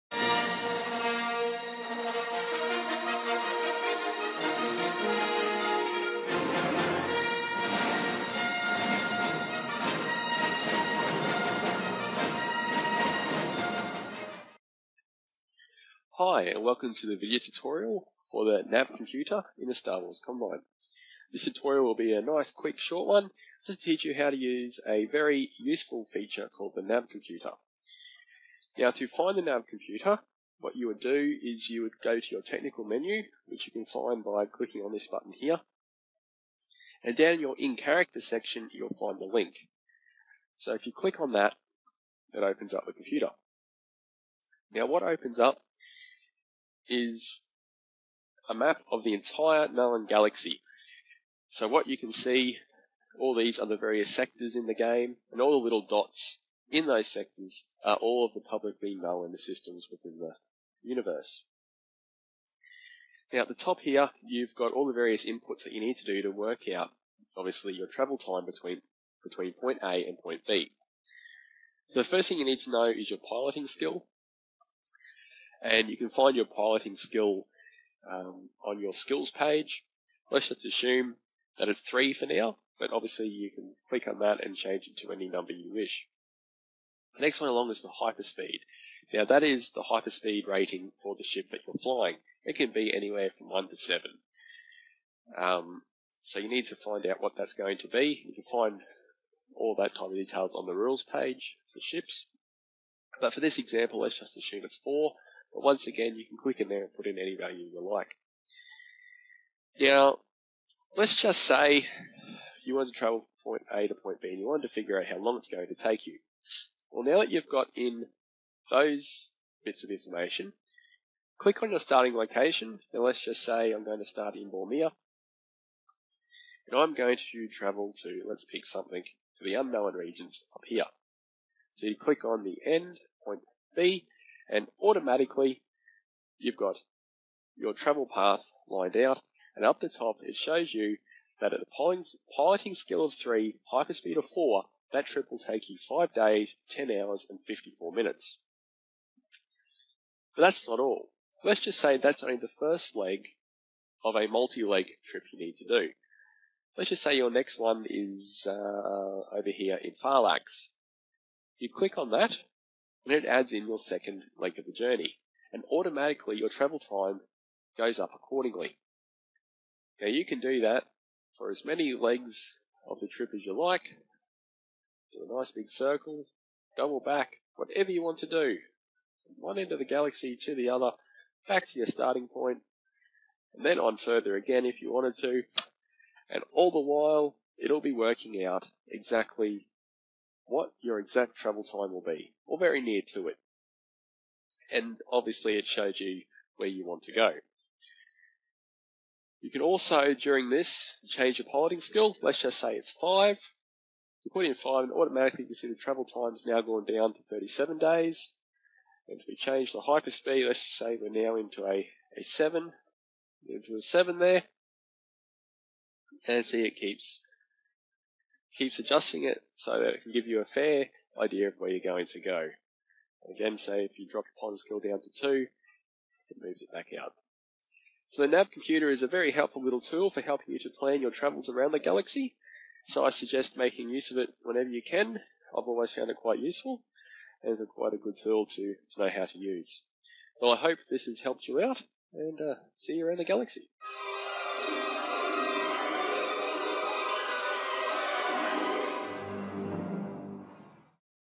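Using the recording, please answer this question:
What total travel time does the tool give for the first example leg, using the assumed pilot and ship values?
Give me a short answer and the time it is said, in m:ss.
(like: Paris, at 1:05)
5 days, 10 hours, and 54 minutes, at 2:25.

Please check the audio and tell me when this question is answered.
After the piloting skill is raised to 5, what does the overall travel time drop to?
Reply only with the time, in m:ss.
3:27.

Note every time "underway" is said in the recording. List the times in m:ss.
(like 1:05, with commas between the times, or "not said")
not said.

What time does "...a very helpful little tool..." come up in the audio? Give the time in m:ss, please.
3:49.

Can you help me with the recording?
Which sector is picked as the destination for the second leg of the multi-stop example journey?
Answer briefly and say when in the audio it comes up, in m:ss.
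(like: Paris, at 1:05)
Farlax, at 2:40.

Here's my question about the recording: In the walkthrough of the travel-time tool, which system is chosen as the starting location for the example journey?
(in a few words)
Bormea.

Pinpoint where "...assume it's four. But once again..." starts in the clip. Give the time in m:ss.
1:44.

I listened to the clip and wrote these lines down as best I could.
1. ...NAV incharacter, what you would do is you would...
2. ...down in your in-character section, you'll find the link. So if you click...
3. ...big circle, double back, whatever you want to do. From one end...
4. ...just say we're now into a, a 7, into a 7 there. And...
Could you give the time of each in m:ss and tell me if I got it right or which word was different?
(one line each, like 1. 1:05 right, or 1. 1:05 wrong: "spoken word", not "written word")
1. 0:29 wrong: "computer", not "incharacter"
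2. 0:37 right
3. 2:55 right
4. 3:30 right.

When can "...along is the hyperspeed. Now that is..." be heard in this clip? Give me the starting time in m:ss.
1:27.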